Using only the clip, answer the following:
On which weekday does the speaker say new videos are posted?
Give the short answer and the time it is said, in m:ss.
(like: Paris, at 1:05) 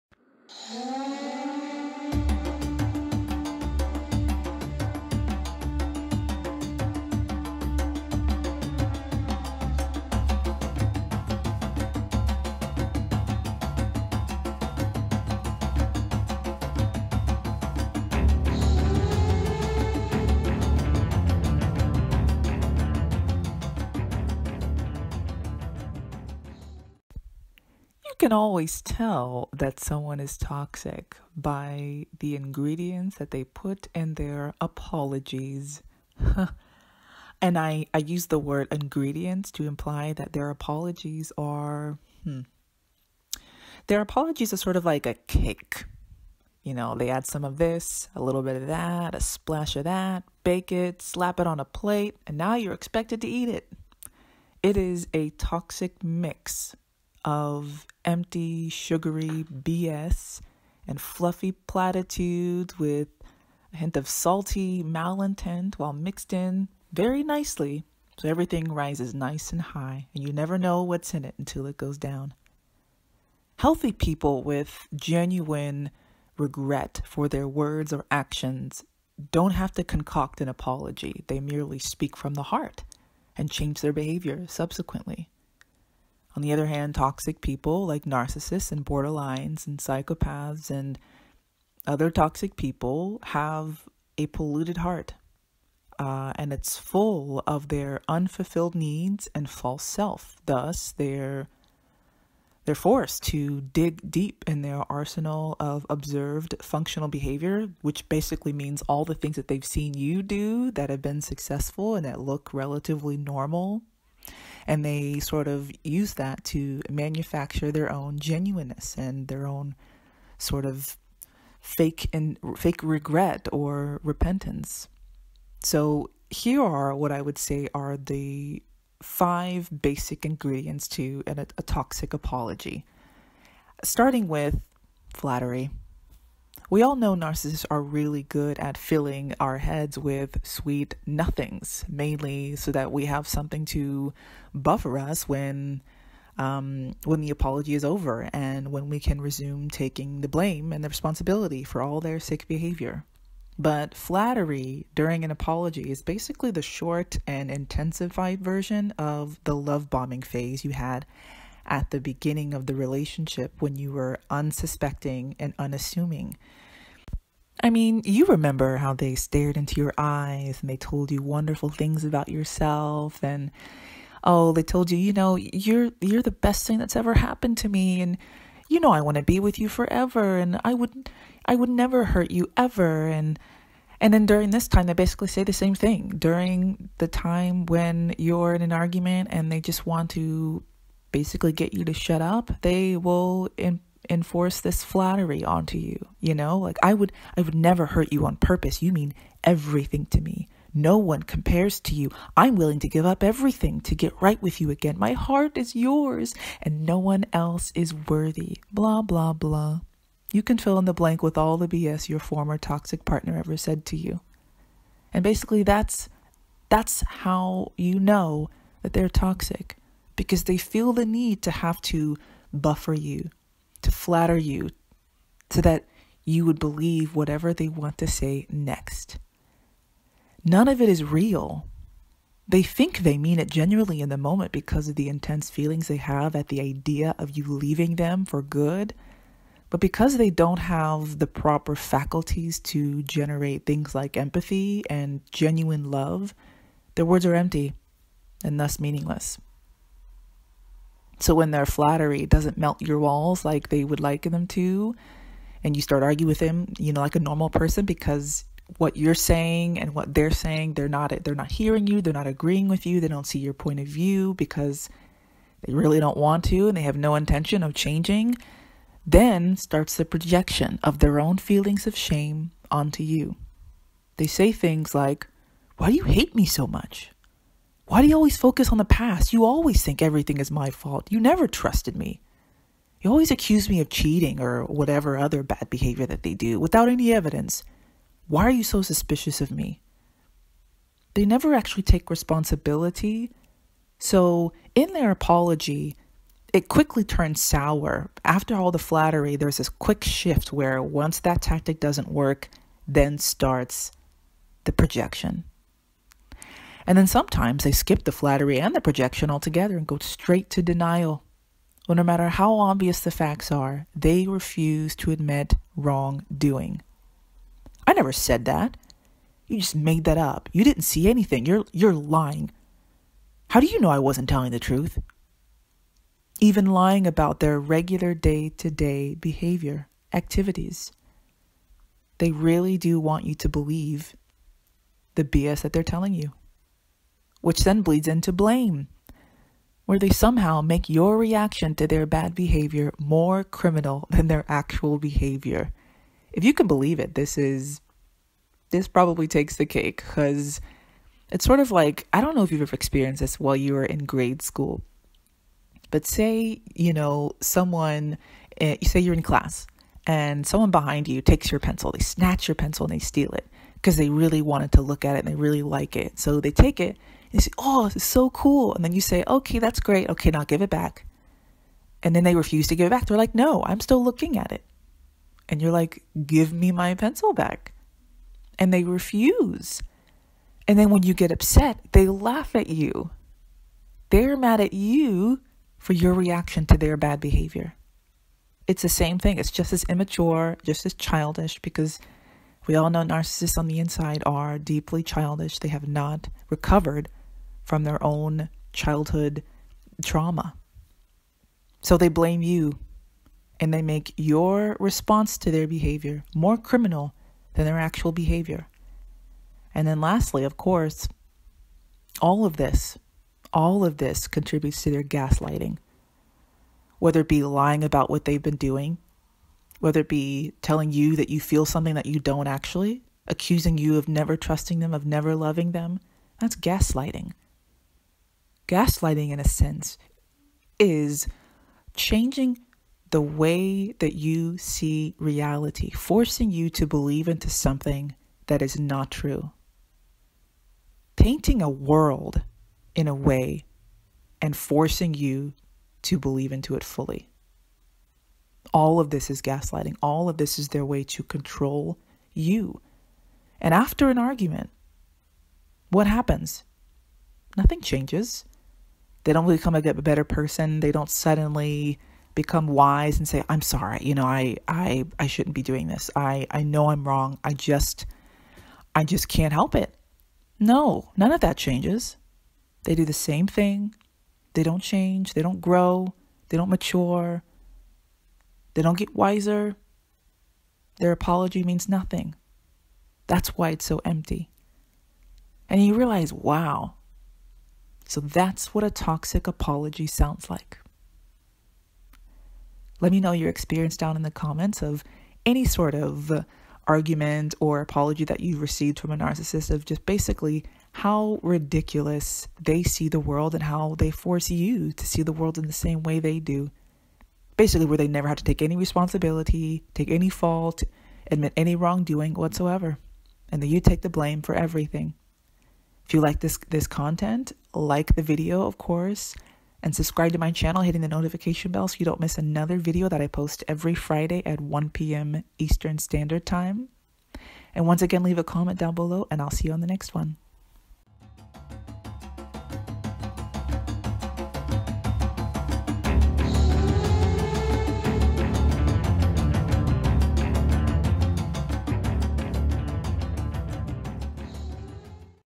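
Friday, at 8:43.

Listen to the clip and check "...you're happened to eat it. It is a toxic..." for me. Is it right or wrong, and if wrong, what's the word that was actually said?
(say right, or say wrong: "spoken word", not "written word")
wrong: "expected", not "happened".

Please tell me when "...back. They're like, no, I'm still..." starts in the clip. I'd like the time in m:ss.
6:12.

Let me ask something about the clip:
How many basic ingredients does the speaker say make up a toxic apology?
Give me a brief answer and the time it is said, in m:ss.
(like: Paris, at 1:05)
5, at 2:09.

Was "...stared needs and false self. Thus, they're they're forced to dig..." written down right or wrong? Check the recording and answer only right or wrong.
wrong.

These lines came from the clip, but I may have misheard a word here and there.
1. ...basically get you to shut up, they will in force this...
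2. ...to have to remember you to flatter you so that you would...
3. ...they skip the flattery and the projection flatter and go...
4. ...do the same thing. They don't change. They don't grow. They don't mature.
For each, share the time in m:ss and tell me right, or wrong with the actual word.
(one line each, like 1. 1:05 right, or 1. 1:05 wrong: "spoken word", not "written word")
1. 3:11 wrong: "enforce", not "force"
2. 3:41 wrong: "buffer", not "remember"
3. 5:07 wrong: "altogether", not "flatter"
4. 7:52 right.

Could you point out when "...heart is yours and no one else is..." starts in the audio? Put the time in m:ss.
3:25.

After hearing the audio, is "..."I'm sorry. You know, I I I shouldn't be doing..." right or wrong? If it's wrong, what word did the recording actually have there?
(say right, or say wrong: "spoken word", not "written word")
right.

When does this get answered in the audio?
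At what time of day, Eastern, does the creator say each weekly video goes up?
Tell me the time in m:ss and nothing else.
8:44.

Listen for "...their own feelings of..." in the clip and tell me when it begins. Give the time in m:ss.
4:30.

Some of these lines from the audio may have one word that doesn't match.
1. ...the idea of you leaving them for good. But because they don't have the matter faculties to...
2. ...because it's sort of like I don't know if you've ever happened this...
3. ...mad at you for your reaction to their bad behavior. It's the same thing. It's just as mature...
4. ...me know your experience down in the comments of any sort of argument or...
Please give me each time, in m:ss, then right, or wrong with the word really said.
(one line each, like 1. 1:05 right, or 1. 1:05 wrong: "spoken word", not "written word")
1. 3:56 wrong: "proper", not "matter"
2. 5:49 wrong: "experienced", not "happened"
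3. 6:24 wrong: "immature", not "mature"
4. 8:13 right.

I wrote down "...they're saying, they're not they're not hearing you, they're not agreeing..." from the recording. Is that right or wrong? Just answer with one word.
right.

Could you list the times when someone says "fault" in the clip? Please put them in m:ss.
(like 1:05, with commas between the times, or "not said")
4:40, 8:30.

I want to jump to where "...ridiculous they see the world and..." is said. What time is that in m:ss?
8:21.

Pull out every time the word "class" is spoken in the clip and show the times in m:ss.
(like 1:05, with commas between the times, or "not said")
5:59.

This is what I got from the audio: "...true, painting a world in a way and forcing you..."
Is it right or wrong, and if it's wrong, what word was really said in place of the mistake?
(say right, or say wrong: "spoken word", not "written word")
right.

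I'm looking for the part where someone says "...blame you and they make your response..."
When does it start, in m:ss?
6:42.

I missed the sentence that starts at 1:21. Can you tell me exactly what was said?
They merely speak from the heart and change their behavior subsequently.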